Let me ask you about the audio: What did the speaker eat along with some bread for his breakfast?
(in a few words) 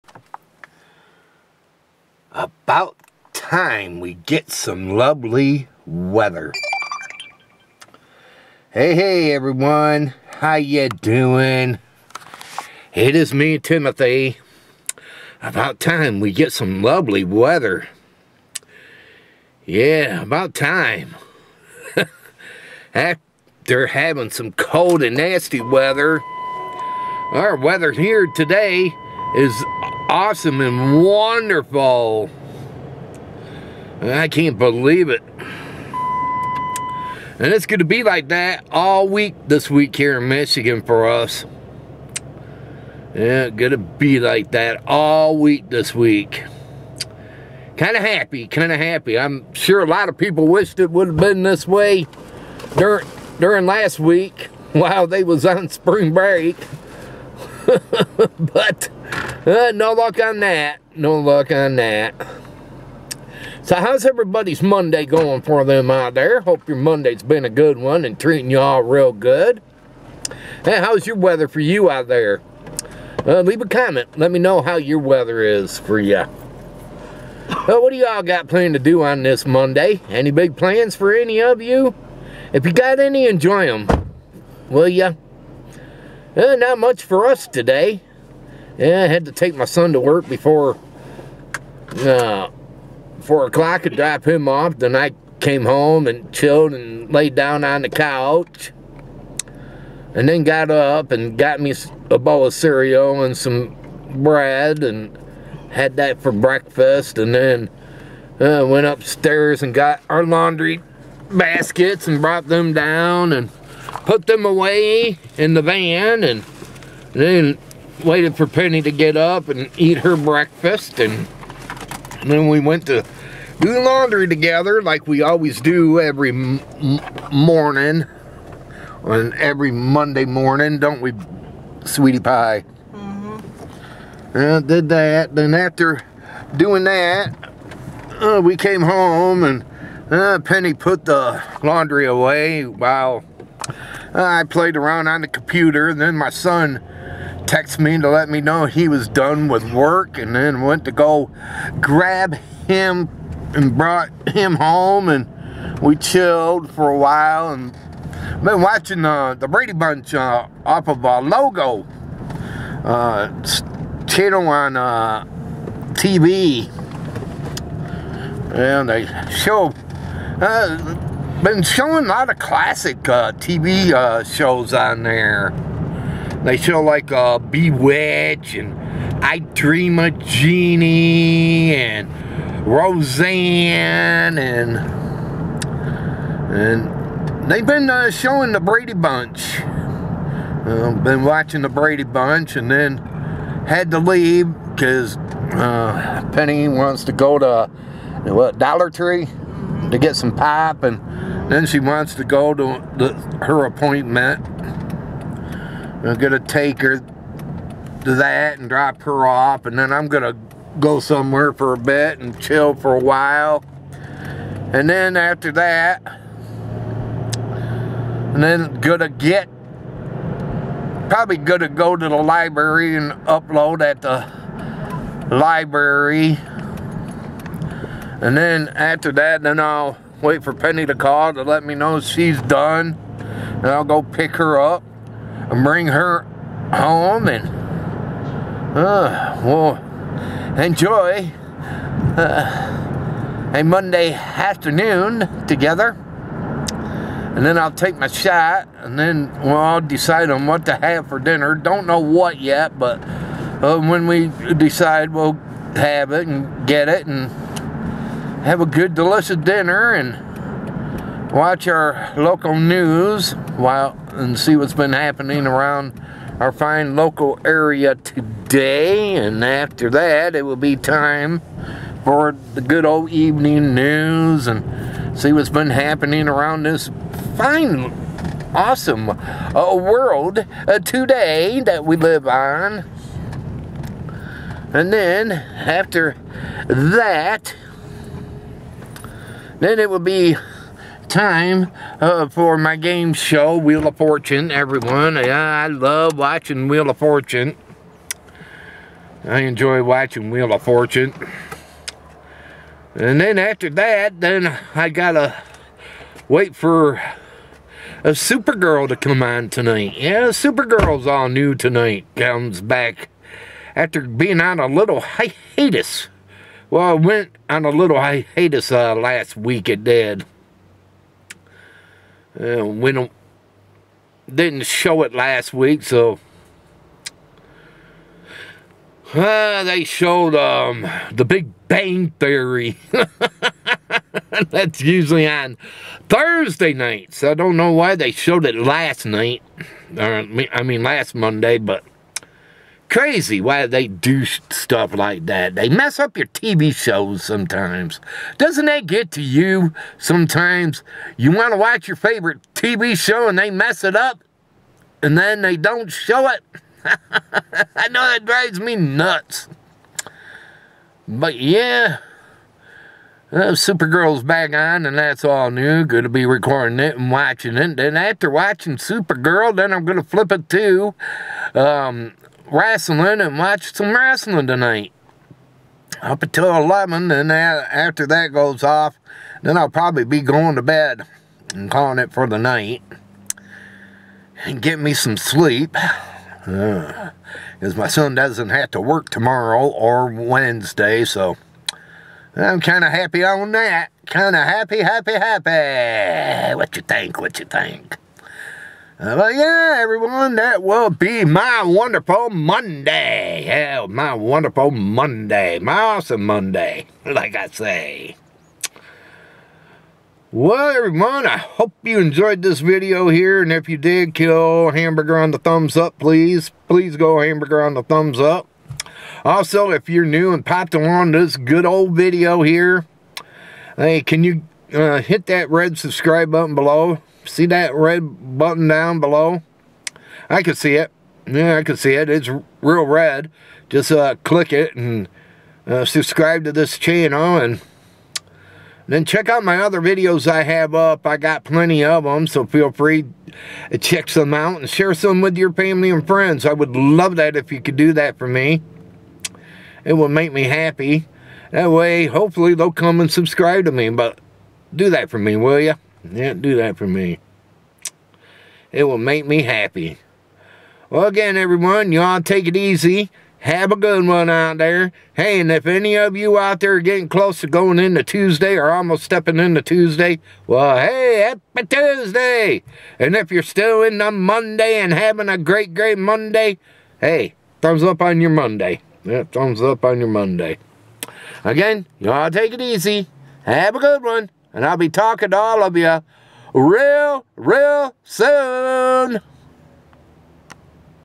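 cereal.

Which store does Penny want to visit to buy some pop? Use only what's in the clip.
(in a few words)
Dollar Tree.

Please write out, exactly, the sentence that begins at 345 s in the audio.
They mess up your TV shows sometimes.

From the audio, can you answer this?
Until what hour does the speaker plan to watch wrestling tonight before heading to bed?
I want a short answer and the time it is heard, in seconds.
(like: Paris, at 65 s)
11, at 376 s.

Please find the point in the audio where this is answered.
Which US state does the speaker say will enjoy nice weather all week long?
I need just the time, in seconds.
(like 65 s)
40 s.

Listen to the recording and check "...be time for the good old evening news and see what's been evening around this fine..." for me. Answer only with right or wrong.
wrong.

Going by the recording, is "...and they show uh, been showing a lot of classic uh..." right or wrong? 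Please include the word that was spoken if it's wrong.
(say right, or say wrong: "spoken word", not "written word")
right.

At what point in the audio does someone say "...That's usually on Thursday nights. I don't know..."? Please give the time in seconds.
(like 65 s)
334 s.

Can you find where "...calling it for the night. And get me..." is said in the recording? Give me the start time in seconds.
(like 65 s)
381 s.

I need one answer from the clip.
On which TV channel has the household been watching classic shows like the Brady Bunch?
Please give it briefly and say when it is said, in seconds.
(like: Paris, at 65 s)
Logo, at 161 s.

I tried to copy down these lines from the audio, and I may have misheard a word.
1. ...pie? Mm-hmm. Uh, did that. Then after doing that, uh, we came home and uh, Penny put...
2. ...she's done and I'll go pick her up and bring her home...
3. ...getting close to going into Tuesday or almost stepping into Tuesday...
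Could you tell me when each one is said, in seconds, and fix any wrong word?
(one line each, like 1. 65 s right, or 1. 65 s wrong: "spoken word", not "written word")
1. 132 s right
2. 231 s right
3. 466 s right.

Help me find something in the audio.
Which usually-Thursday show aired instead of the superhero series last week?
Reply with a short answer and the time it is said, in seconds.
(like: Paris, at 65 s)
The Big Bang Theory, at 331 s.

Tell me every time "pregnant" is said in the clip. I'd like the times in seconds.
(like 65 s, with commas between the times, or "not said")
not said.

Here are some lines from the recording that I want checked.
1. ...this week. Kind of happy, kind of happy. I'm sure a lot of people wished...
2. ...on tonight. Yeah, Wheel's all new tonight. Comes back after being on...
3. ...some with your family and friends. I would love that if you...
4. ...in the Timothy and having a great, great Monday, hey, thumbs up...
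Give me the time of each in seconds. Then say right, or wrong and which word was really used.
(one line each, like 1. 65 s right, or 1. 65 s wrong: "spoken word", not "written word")
1. 45 s right
2. 309 s wrong: "Supergirl", not "Wheel"
3. 444 s right
4. 473 s wrong: "Monday", not "Timothy".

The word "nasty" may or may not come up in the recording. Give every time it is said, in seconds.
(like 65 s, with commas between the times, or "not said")
25 s.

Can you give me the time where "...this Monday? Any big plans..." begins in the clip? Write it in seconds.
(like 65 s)
79 s.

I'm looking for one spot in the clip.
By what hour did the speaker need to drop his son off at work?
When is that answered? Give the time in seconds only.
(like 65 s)
93 s.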